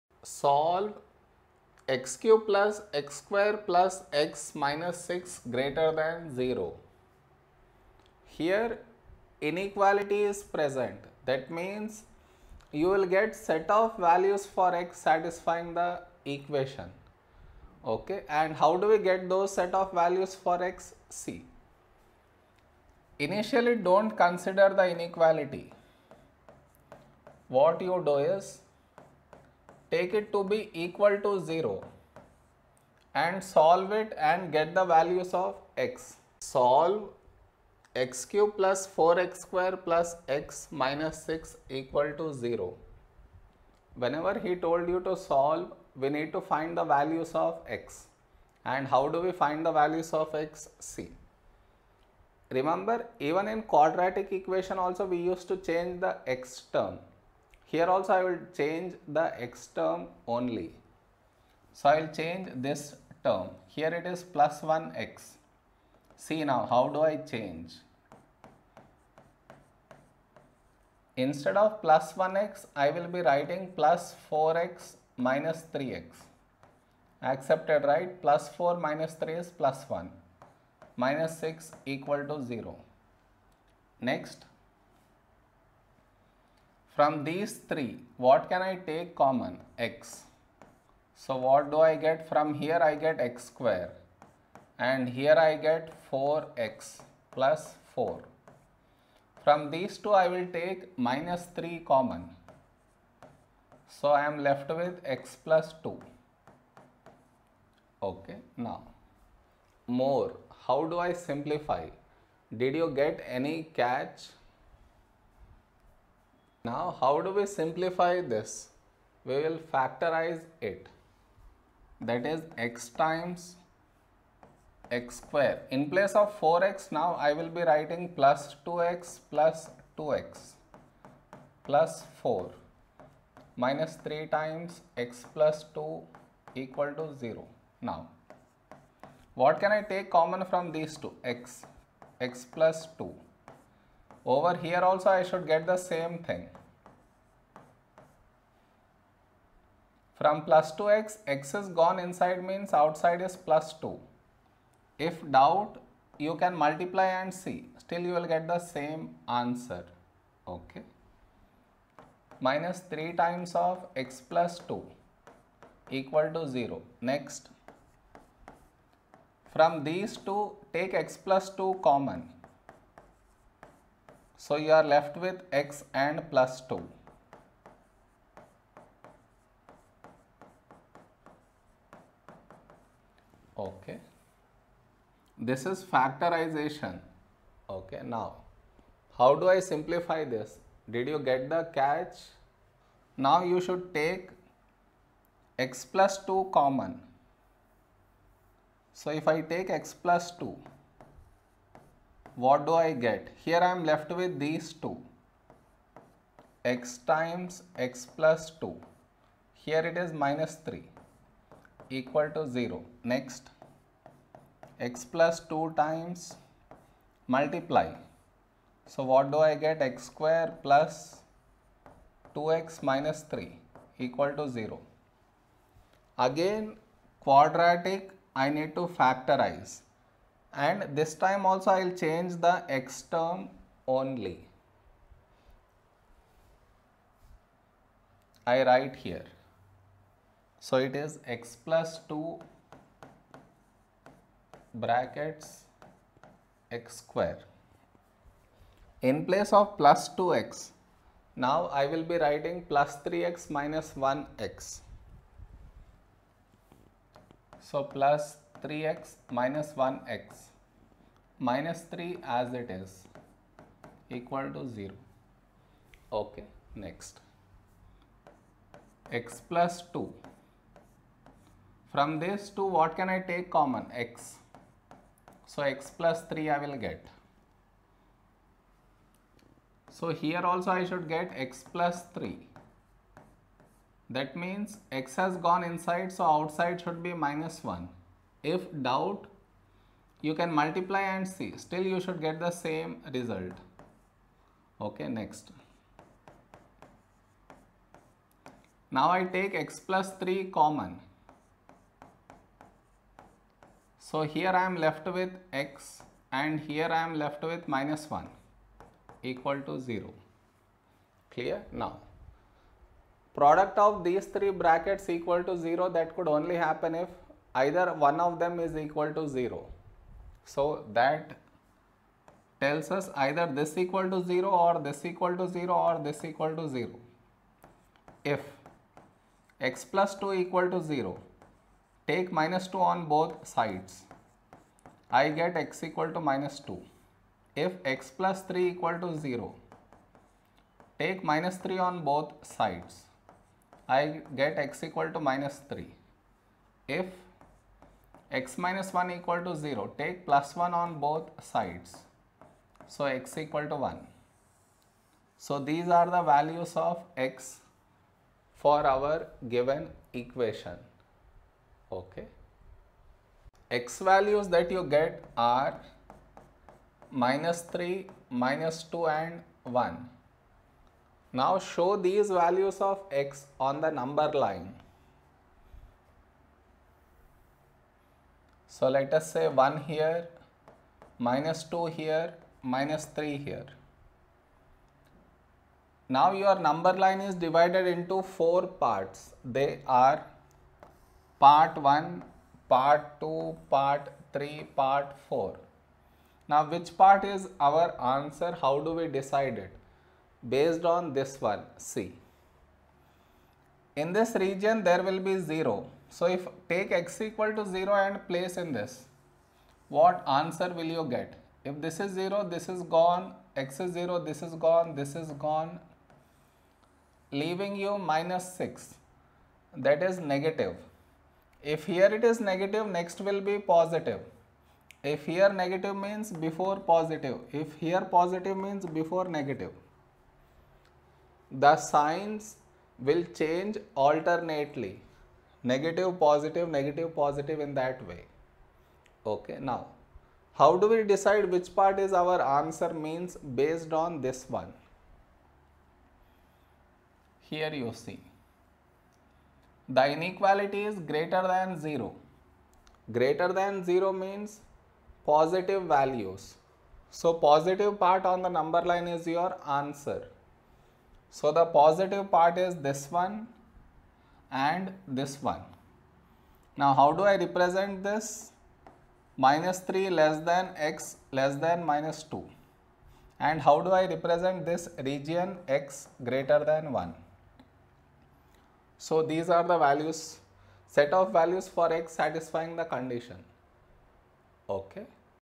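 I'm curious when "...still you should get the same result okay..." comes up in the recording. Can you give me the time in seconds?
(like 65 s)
291 s.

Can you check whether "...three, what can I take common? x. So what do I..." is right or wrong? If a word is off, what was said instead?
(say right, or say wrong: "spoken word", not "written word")
right.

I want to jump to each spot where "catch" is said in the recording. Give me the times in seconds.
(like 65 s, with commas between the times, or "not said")
113 s, 191 s.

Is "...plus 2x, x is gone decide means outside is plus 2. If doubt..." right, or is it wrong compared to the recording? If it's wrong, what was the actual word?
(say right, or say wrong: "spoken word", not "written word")
wrong: "inside", not "decide".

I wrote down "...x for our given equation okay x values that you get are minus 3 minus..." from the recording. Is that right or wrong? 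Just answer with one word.
right.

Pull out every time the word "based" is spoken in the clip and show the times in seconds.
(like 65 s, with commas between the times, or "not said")
400 s, 443 s.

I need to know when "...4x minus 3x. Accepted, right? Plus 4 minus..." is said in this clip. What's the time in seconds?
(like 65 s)
74 s.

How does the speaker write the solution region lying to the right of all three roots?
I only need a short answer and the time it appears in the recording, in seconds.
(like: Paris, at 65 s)
x > 1, at 475 s.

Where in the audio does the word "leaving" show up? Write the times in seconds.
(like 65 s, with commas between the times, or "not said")
417 s.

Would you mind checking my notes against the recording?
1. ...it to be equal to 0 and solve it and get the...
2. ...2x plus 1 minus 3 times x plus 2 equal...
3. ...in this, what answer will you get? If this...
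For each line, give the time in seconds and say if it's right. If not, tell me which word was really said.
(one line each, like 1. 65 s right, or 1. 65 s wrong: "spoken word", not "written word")
1. 30 s right
2. 129 s wrong: "4", not "1"
3. 408 s right.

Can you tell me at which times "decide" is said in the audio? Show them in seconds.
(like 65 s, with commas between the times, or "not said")
399 s, 441 s.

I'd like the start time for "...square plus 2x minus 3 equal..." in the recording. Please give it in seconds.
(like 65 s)
220 s.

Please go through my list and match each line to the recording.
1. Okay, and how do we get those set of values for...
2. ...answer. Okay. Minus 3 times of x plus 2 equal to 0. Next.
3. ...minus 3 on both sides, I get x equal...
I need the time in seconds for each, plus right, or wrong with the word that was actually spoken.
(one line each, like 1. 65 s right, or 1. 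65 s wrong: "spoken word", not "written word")
1. 17 s right
2. 159 s right
3. 341 s right.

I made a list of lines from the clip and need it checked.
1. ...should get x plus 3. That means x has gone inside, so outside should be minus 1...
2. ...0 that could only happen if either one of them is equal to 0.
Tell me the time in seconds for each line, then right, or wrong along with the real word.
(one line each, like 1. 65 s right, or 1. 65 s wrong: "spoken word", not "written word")
1. 280 s right
2. 315 s right.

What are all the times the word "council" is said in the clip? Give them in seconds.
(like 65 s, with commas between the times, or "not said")
not said.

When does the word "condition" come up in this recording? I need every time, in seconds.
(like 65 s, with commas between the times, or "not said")
482 s.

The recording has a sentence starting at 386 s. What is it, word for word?
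Now your number line is divided into 4 parts.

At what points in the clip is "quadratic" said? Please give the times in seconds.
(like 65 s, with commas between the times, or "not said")
53 s, 227 s.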